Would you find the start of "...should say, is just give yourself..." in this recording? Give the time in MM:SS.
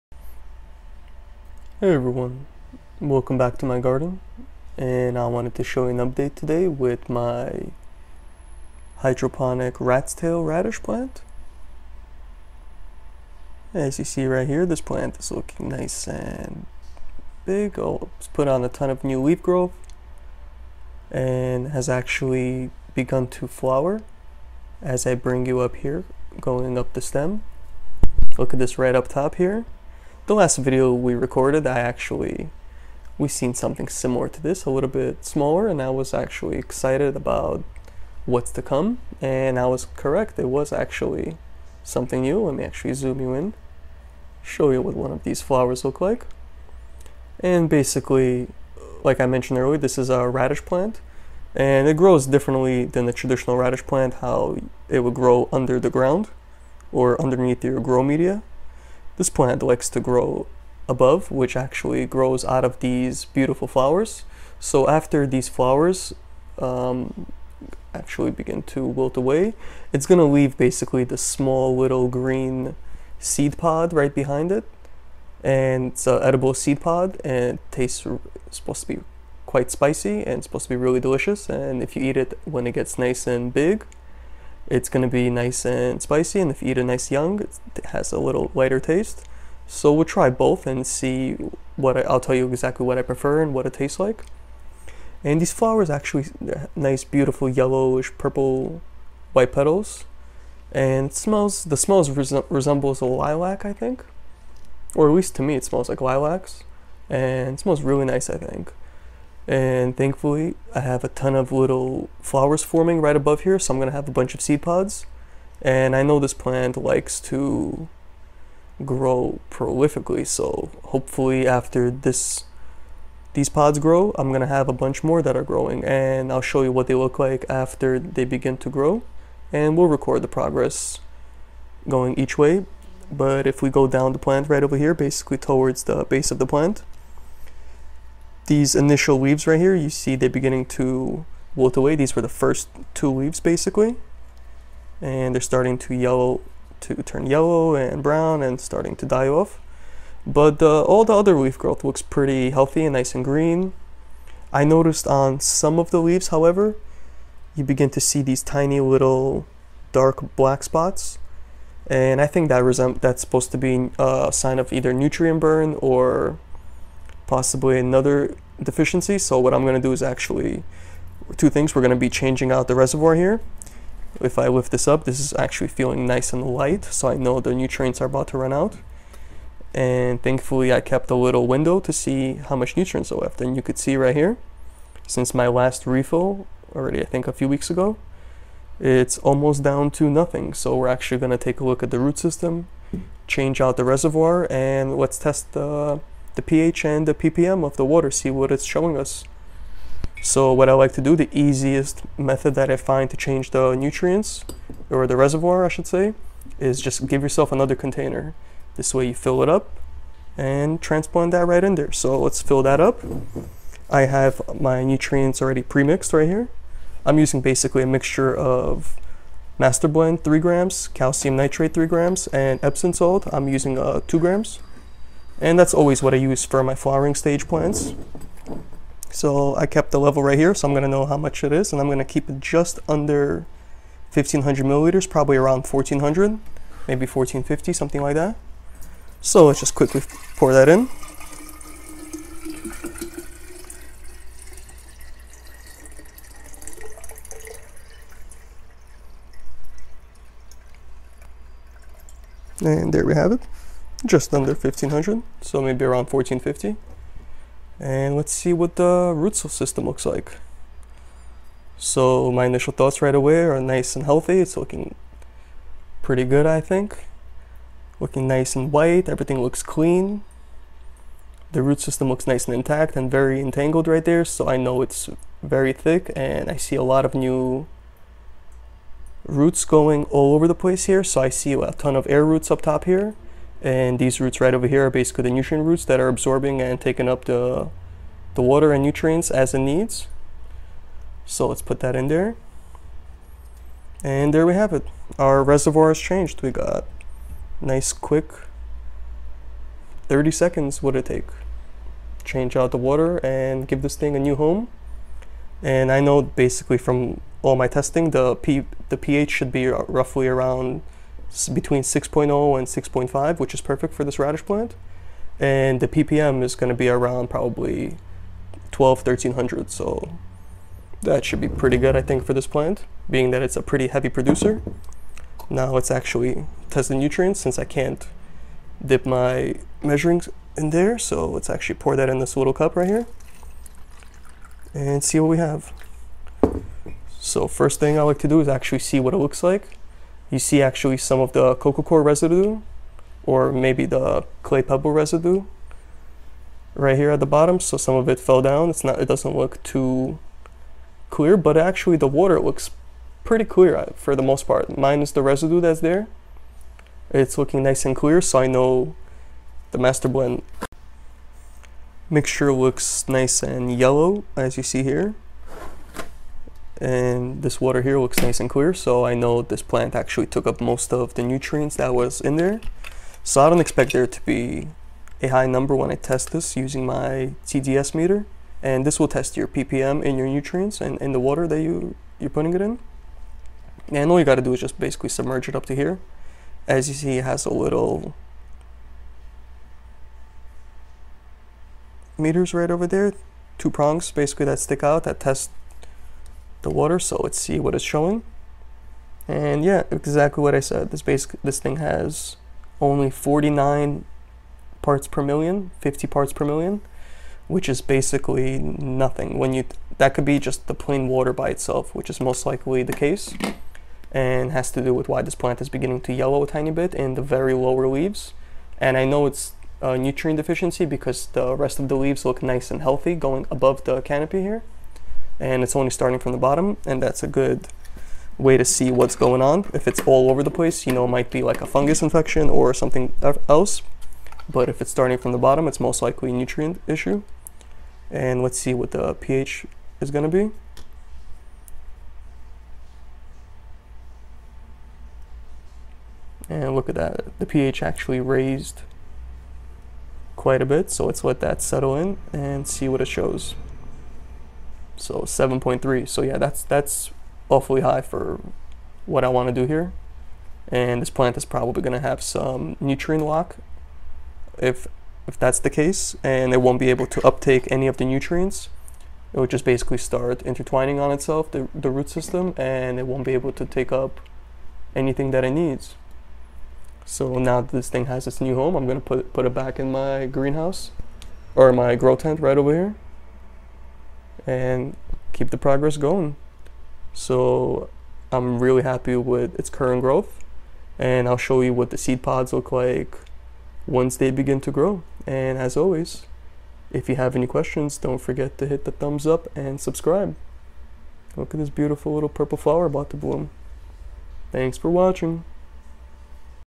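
03:25.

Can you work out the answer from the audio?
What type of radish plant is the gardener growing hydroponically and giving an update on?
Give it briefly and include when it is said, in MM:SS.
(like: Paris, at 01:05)
Rat's tail radish, at 00:09.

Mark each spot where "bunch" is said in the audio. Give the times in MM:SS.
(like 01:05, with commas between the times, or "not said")
01:54, 02:04.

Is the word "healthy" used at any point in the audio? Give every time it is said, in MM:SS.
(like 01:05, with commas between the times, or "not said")
02:32, 04:24, 07:02.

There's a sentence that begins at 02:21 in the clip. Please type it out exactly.
These were the first two leaves basically.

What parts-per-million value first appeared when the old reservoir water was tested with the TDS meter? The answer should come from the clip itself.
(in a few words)
49.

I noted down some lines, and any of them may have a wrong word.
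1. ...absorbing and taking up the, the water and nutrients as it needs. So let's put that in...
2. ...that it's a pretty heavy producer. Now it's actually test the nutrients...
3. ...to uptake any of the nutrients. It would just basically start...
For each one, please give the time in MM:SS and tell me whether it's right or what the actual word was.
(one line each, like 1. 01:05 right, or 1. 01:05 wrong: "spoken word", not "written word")
1. 04:46 right
2. 05:23 right
3. 07:47 right.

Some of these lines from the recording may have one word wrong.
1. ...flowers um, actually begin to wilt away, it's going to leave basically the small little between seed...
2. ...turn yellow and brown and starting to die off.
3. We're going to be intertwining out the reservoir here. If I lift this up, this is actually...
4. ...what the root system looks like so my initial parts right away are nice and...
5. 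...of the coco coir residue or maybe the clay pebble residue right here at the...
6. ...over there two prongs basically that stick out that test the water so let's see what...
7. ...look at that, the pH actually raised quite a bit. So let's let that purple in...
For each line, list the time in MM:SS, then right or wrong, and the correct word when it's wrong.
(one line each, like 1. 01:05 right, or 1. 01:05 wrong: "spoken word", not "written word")
1. 01:05 wrong: "green", not "between"
2. 02:27 right
3. 02:51 wrong: "changing", not "intertwining"
4. 04:18 wrong: "thoughts", not "parts"
5. 05:41 right
6. 06:32 right
7. 07:26 wrong: "settle", not "purple".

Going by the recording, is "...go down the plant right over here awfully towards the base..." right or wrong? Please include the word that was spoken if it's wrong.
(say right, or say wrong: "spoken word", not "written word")
wrong: "basically", not "awfully".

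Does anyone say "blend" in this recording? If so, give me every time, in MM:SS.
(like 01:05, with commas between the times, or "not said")
03:39, 06:00.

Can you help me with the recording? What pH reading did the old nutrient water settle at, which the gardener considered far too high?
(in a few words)
7.3.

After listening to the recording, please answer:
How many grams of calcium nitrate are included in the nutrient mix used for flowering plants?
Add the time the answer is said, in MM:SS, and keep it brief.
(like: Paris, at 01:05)
3 grams, at 03:40.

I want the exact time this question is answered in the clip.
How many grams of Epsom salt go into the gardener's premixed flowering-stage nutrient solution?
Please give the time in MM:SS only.
03:44.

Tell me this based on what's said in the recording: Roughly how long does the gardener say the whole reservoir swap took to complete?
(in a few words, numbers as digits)
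30 seconds.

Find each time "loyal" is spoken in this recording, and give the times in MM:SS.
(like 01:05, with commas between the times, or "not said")
not said.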